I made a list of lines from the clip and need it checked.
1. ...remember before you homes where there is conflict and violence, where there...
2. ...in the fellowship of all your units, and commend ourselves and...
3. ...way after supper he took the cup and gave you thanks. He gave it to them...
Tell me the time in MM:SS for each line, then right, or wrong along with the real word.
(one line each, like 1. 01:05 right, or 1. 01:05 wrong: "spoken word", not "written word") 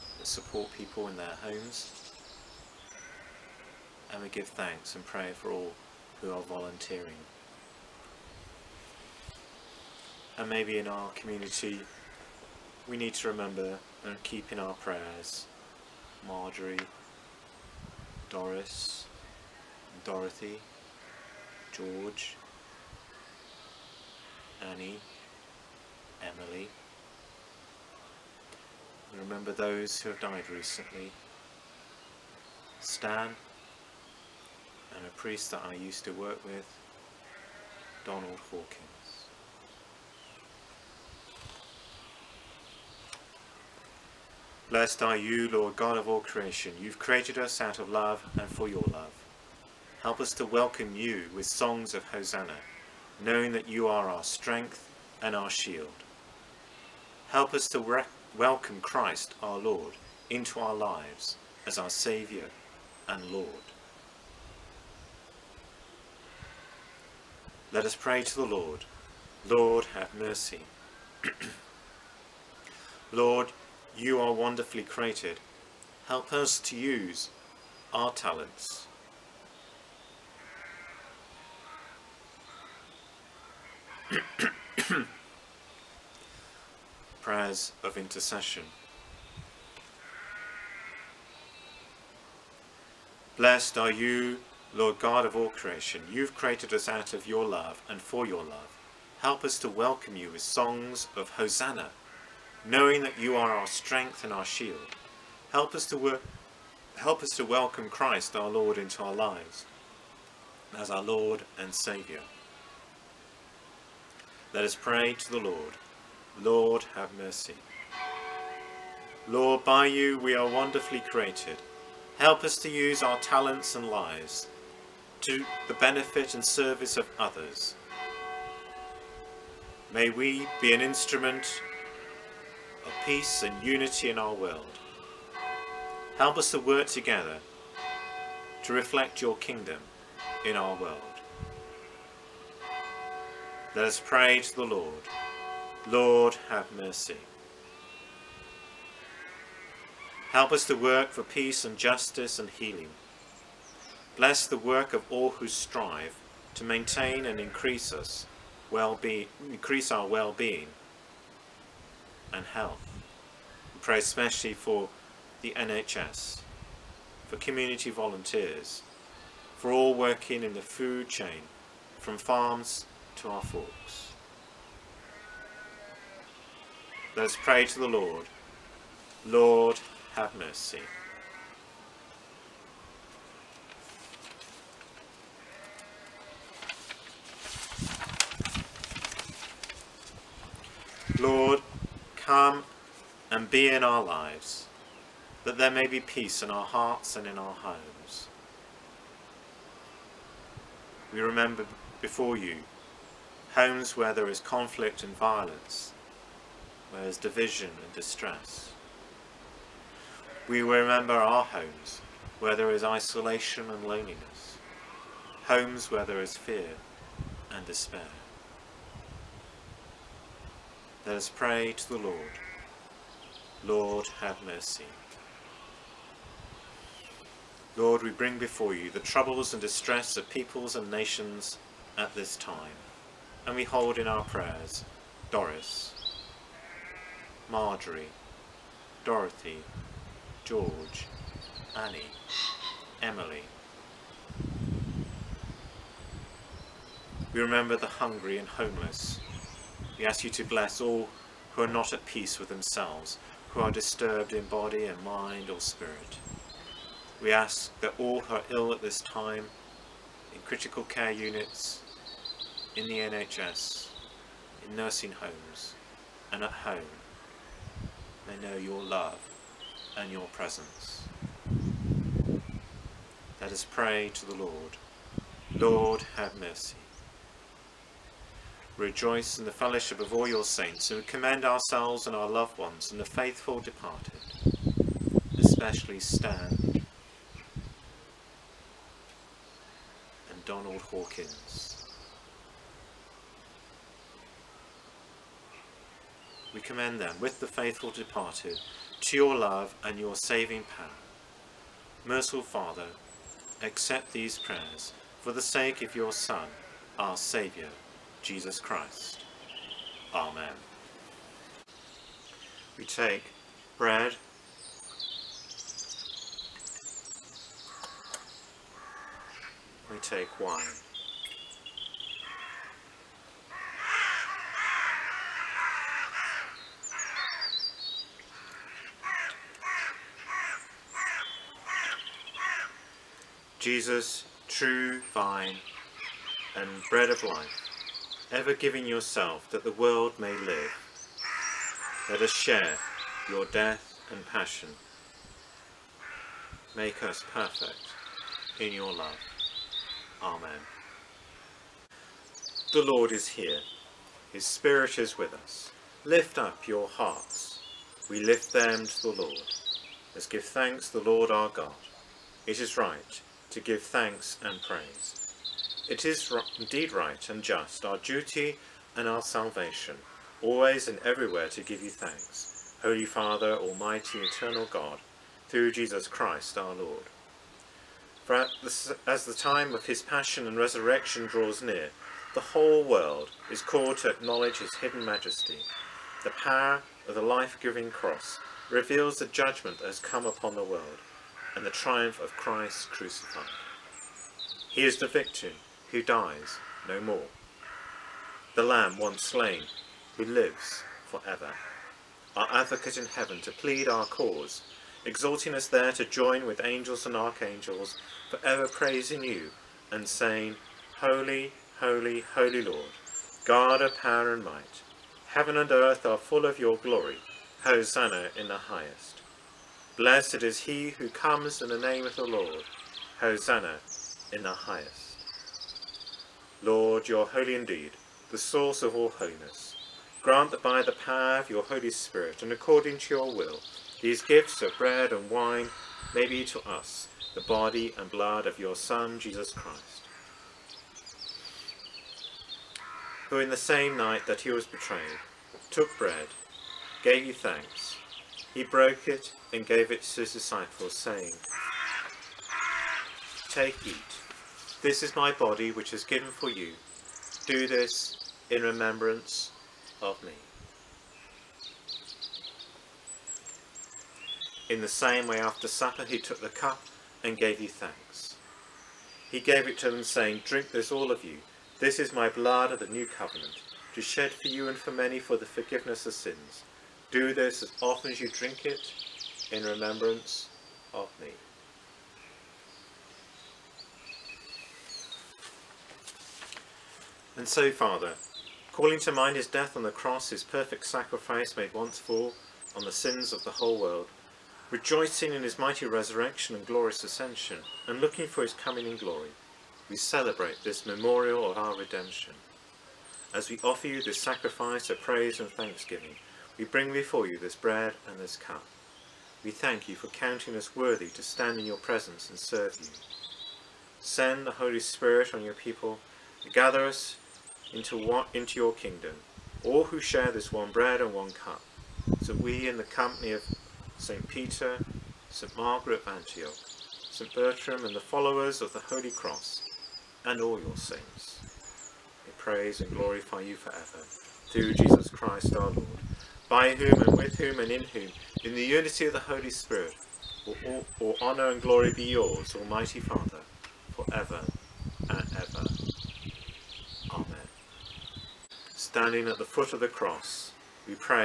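1. 03:21 right
2. 04:39 wrong: "saints", not "units"
3. 07:45 right.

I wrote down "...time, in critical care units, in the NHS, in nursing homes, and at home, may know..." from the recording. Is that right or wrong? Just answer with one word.
right.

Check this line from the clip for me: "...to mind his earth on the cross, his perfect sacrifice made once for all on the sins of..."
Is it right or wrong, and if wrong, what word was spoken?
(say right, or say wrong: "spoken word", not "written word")
wrong: "death", not "earth".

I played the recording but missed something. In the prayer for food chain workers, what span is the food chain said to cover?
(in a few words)
From farms to our forks.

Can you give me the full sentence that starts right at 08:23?
As we offer you this sacrifice of praise and thanksgiving, we bring before you this bread and this cup.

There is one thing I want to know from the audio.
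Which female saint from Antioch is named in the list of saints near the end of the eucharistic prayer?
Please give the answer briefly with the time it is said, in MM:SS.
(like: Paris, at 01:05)
St. Margaret of Antioch, at 08:45.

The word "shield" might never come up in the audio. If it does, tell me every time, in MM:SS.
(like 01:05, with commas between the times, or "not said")
00:55, 01:44.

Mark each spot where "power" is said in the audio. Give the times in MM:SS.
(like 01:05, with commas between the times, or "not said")
05:00, 06:26, 06:53, 07:10.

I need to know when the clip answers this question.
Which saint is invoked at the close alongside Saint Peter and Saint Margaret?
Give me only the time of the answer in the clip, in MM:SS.
08:47.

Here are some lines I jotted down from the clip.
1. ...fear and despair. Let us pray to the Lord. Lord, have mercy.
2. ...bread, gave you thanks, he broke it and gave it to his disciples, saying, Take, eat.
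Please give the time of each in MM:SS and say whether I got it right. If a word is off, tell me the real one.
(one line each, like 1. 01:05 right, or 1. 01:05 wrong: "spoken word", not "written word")
1. 03:36 right
2. 07:25 right.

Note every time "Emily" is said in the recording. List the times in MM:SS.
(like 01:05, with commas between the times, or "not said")
00:26, 04:03.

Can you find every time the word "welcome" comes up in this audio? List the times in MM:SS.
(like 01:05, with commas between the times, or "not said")
00:50, 00:58, 01:39, 01:47.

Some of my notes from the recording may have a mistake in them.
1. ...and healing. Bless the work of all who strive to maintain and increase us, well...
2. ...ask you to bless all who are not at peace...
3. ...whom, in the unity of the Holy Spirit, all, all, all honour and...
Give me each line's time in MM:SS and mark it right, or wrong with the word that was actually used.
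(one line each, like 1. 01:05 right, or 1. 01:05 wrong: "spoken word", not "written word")
1. 02:32 right
2. 04:10 right
3. 08:57 right.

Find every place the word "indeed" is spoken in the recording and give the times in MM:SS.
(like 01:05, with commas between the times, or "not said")
06:06, 07:07.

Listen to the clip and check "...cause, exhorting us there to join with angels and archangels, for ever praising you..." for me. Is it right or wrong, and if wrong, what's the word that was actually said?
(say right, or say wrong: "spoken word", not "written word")
right.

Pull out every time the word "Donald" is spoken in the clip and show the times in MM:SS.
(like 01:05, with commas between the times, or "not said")
00:38, 04:50.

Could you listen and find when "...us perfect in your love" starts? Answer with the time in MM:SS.
05:47.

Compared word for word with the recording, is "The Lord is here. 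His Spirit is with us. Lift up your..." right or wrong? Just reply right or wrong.
right.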